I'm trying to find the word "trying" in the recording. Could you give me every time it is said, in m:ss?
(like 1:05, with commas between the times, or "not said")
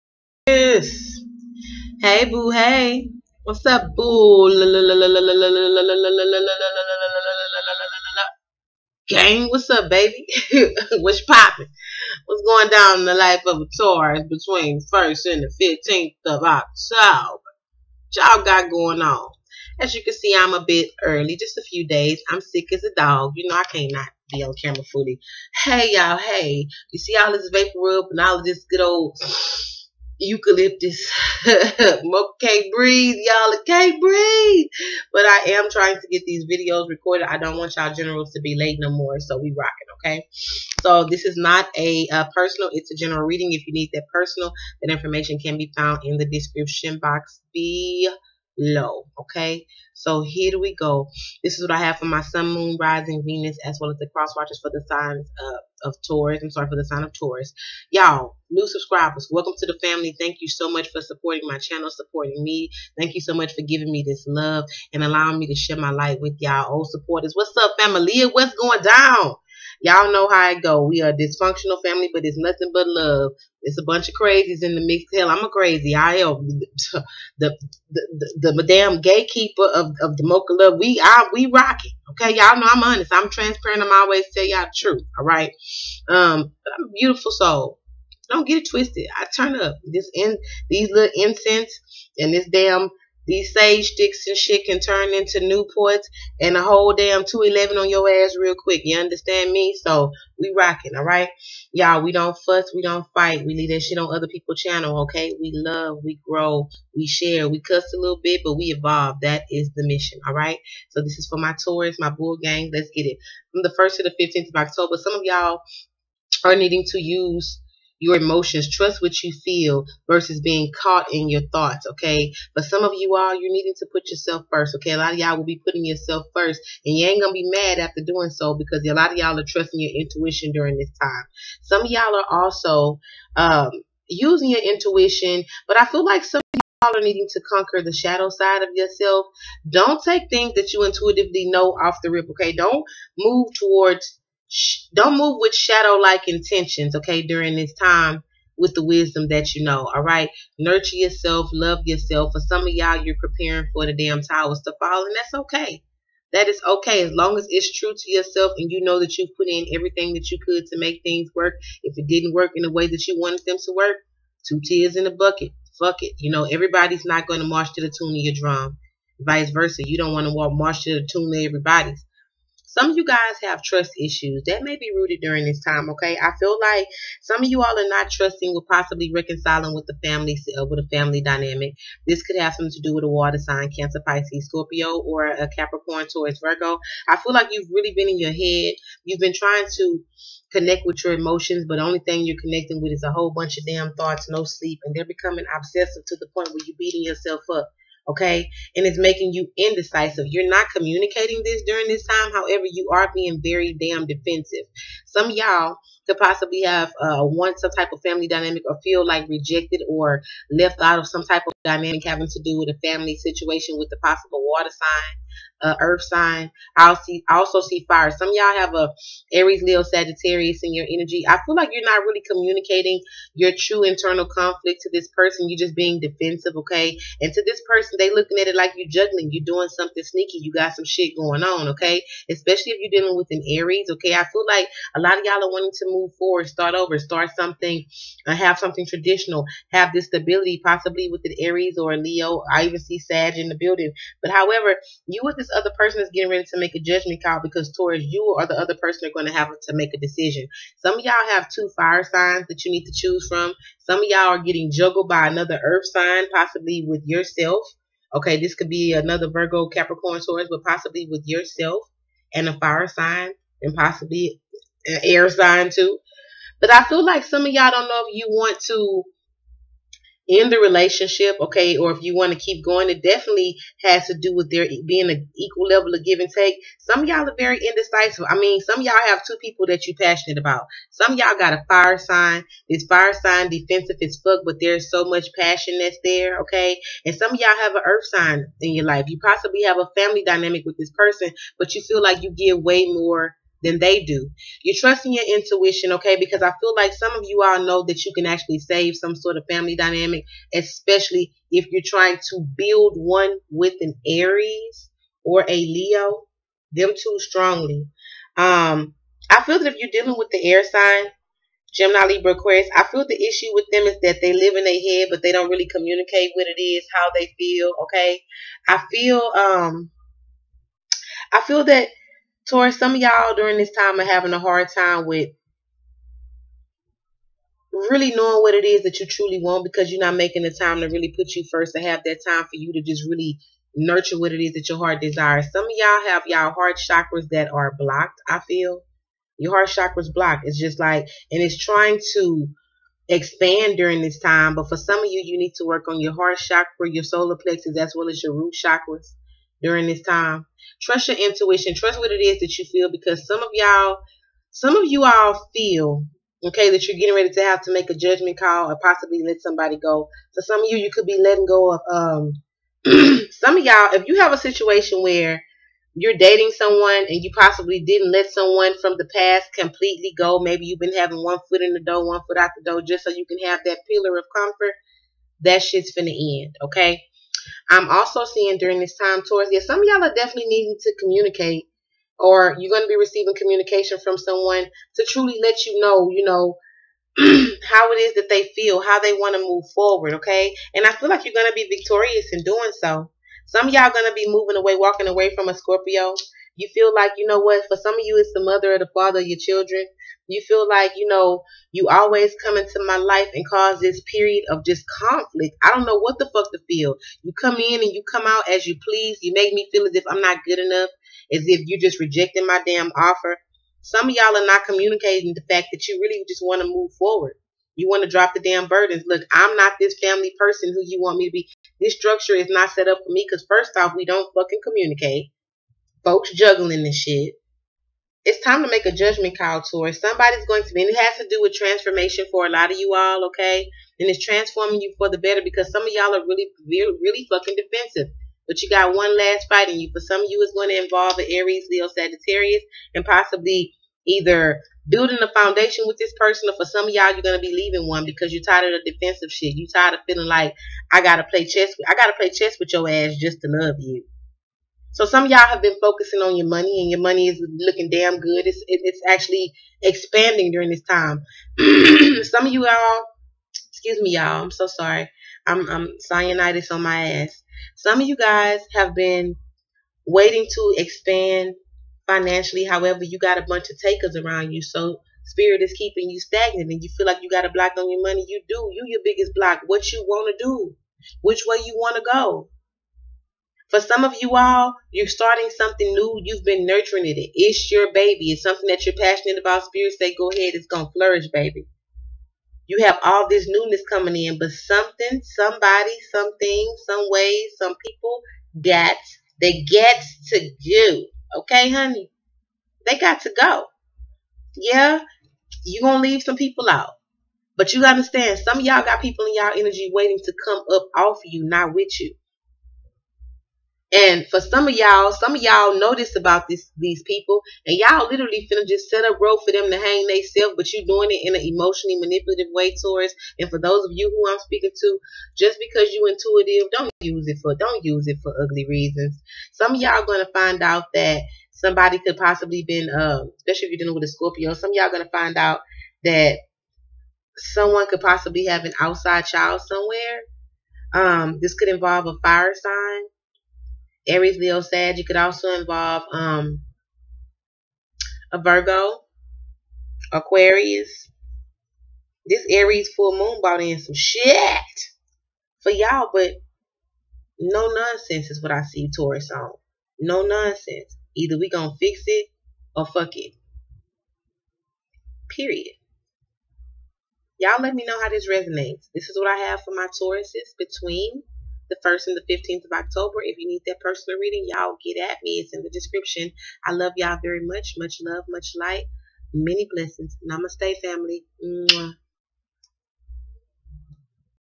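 0:35, 3:09, 5:01, 5:41.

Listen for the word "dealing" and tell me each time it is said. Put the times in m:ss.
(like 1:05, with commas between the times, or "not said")
3:53, 5:09, 8:53.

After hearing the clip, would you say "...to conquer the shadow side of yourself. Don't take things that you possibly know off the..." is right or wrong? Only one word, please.
wrong.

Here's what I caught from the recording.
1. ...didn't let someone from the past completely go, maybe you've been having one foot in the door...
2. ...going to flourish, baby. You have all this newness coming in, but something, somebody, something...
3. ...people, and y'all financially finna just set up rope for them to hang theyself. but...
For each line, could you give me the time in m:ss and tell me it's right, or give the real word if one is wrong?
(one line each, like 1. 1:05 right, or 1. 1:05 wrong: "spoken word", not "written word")
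1. 6:07 right
2. 8:10 right
3. 8:37 wrong: "literally", not "financially".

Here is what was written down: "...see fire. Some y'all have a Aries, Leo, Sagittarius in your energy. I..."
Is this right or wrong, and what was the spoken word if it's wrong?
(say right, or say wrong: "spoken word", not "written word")
right.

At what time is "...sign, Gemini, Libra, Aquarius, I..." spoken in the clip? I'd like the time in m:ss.
5:10.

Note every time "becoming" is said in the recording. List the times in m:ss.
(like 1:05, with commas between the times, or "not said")
3:15.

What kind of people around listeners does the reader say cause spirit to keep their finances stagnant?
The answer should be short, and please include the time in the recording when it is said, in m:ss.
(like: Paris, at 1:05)
takers, at 7:53.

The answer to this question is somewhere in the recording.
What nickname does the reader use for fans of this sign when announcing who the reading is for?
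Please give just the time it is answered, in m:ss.
1:52.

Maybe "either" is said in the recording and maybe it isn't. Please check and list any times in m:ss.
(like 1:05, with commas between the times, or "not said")
7:24, 9:21.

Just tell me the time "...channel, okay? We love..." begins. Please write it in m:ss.
1:44.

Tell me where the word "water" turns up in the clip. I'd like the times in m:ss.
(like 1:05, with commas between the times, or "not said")
3:03, 3:34.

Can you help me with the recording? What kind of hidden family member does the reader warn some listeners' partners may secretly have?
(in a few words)
an outside child.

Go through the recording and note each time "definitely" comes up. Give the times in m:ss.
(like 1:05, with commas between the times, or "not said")
4:33, 6:20.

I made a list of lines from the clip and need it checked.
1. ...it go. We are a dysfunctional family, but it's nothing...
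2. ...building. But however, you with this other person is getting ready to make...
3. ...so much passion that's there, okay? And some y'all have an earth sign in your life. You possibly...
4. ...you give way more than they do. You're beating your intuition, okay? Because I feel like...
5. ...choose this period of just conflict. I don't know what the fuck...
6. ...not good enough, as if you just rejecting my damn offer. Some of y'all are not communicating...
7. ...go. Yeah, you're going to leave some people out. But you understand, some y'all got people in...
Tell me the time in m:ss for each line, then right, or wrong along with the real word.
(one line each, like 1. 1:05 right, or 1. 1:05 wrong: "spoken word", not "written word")
1. 1:10 right
2. 4:03 right
3. 4:44 right
4. 4:52 wrong: "trusting", not "beating"
5. 6:43 wrong: "cause", not "choose"
6. 6:50 right
7. 8:23 right.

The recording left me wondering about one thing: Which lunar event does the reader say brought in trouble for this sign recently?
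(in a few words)
Aries full moon.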